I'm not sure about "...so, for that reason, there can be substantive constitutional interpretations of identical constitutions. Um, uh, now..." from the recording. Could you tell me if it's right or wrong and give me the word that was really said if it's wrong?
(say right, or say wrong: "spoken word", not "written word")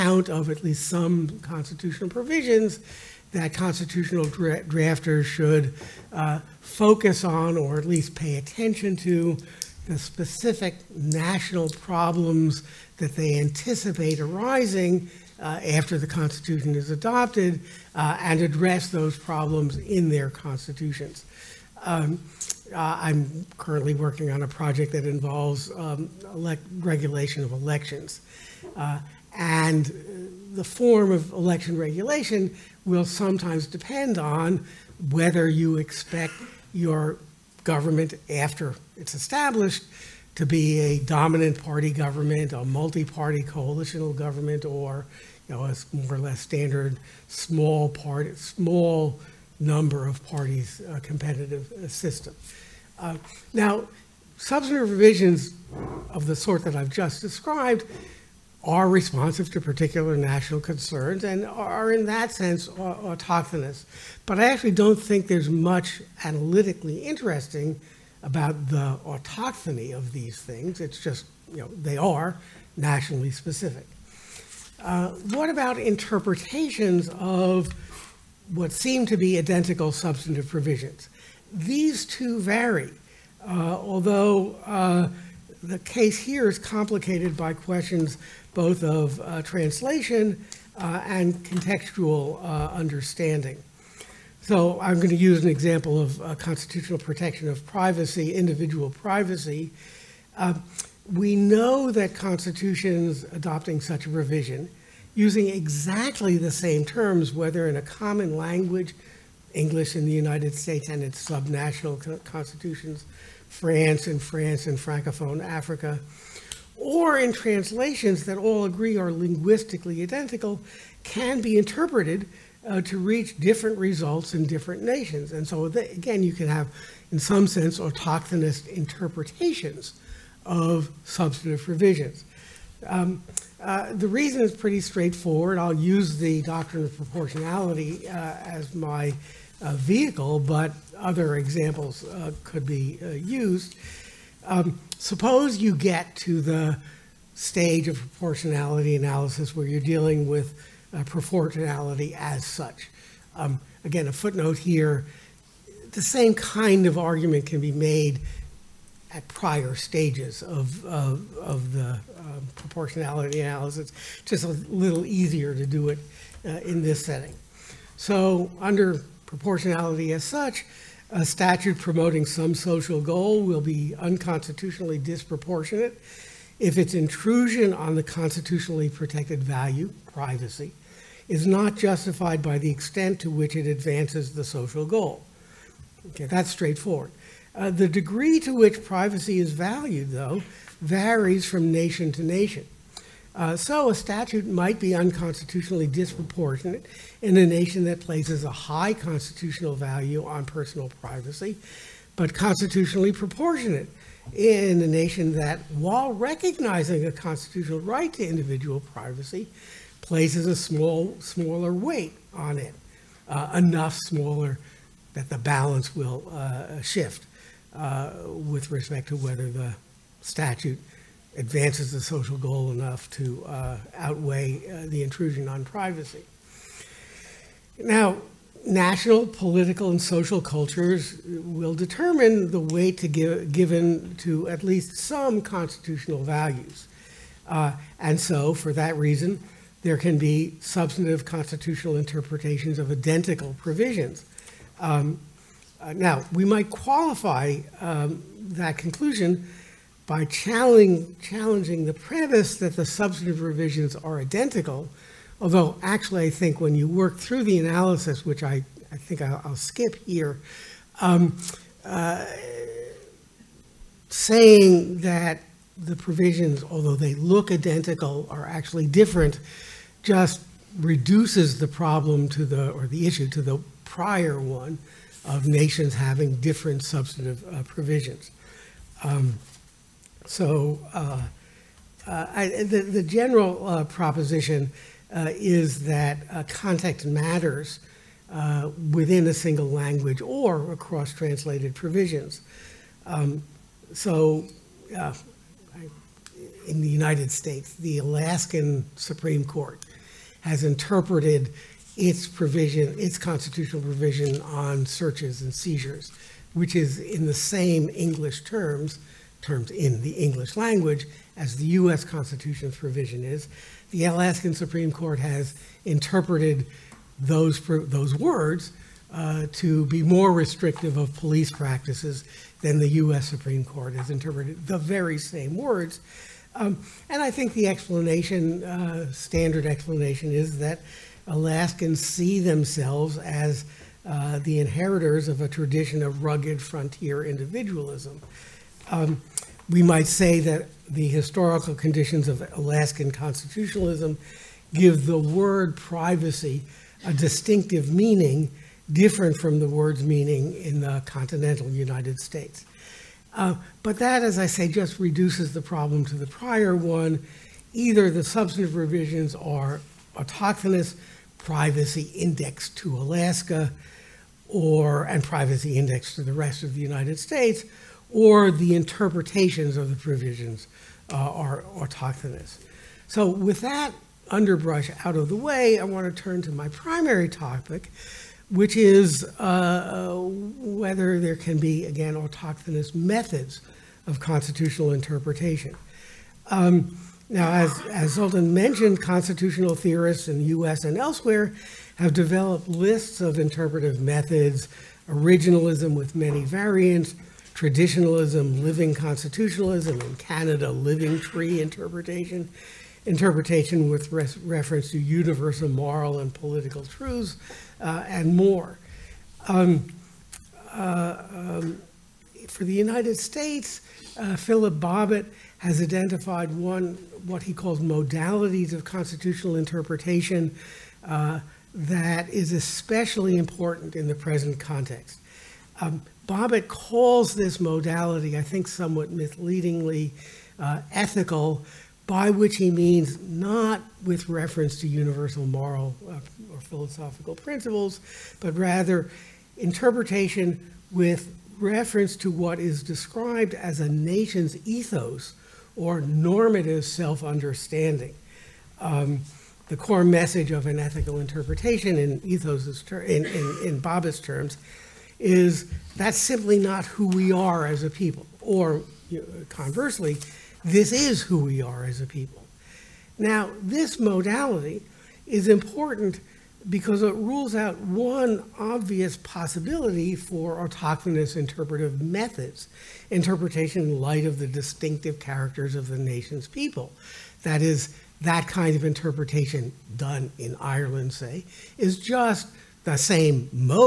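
wrong: "provisions", not "constitutions".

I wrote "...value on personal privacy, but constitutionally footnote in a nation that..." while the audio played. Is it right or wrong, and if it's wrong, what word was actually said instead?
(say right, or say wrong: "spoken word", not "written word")
wrong: "proportionate", not "footnote".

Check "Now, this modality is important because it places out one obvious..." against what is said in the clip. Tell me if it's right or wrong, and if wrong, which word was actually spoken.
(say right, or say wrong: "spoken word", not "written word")
wrong: "rules", not "places".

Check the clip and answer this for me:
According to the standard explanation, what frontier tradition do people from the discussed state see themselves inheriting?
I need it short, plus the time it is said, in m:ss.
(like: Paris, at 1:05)
Rugged frontier individualism, at 5:36.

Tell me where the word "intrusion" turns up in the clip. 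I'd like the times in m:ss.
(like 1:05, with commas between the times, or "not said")
2:56, 3:45.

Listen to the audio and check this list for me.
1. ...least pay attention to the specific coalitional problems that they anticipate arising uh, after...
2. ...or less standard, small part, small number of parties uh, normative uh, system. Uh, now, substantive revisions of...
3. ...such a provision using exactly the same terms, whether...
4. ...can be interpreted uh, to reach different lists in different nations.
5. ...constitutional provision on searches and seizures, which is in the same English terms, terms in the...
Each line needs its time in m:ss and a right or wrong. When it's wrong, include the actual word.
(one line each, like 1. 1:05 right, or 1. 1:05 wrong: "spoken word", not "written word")
1. 0:07 wrong: "national", not "coalitional"
2. 0:46 wrong: "competitive", not "normative"
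3. 1:43 right
4. 2:01 wrong: "results", not "lists"
5. 5:03 right.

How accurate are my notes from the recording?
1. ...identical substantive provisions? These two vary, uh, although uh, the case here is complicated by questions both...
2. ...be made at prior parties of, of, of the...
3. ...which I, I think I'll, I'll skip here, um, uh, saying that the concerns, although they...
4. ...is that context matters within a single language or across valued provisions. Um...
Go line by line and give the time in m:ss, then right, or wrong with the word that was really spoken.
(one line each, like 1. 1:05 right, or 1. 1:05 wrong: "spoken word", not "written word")
1. 1:19 right
2. 2:37 wrong: "stages", not "parties"
3. 4:18 wrong: "provisions", not "concerns"
4. 4:45 wrong: "translated", not "valued".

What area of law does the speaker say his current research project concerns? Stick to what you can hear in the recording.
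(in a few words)
Regulation of elections.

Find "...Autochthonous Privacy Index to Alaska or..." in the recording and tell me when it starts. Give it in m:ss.
6:00.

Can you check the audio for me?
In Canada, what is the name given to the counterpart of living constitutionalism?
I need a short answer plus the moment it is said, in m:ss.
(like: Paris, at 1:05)
Living tree interpretation, at 6:40.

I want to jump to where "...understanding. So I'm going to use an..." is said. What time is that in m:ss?
1:32.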